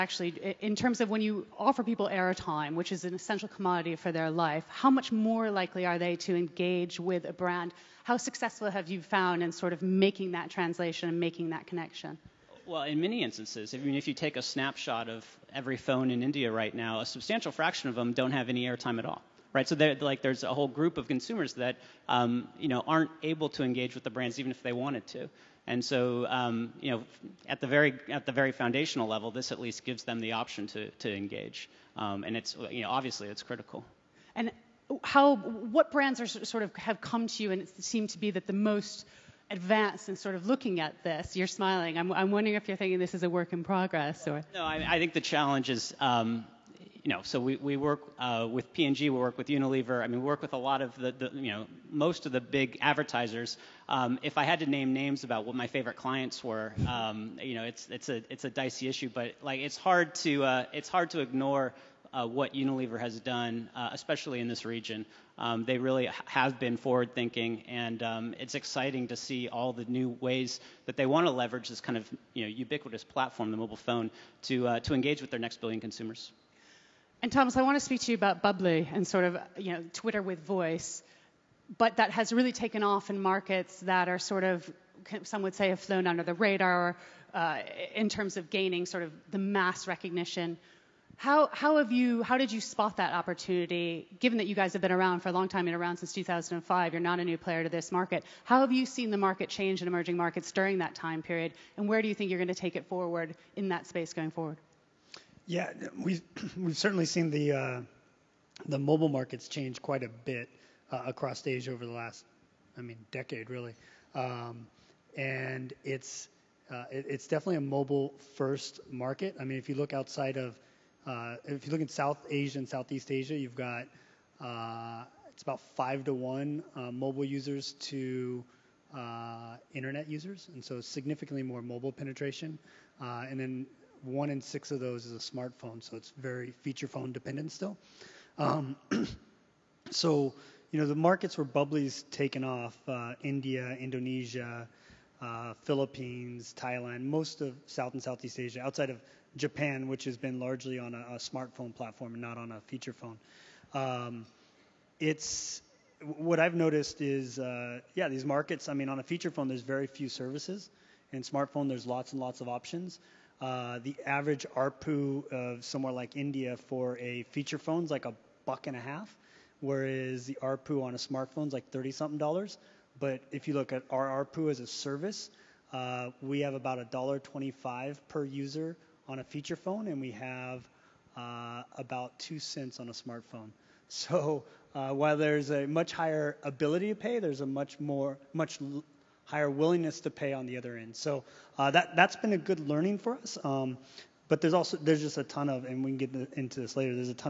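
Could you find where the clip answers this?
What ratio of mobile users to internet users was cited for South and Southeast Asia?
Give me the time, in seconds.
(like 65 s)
125 s.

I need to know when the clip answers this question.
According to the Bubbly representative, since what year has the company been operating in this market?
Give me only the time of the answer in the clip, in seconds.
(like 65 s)
96 s.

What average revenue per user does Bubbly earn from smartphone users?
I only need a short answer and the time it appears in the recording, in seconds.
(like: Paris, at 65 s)
2 cents, at 182 s.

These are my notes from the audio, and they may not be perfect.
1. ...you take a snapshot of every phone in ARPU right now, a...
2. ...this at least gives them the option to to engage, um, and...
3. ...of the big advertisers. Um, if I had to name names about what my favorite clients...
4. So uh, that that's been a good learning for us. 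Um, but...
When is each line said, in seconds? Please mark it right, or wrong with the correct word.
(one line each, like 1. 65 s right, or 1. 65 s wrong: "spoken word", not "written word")
1. 14 s wrong: "India", not "ARPU"
2. 29 s right
3. 52 s right
4. 190 s right.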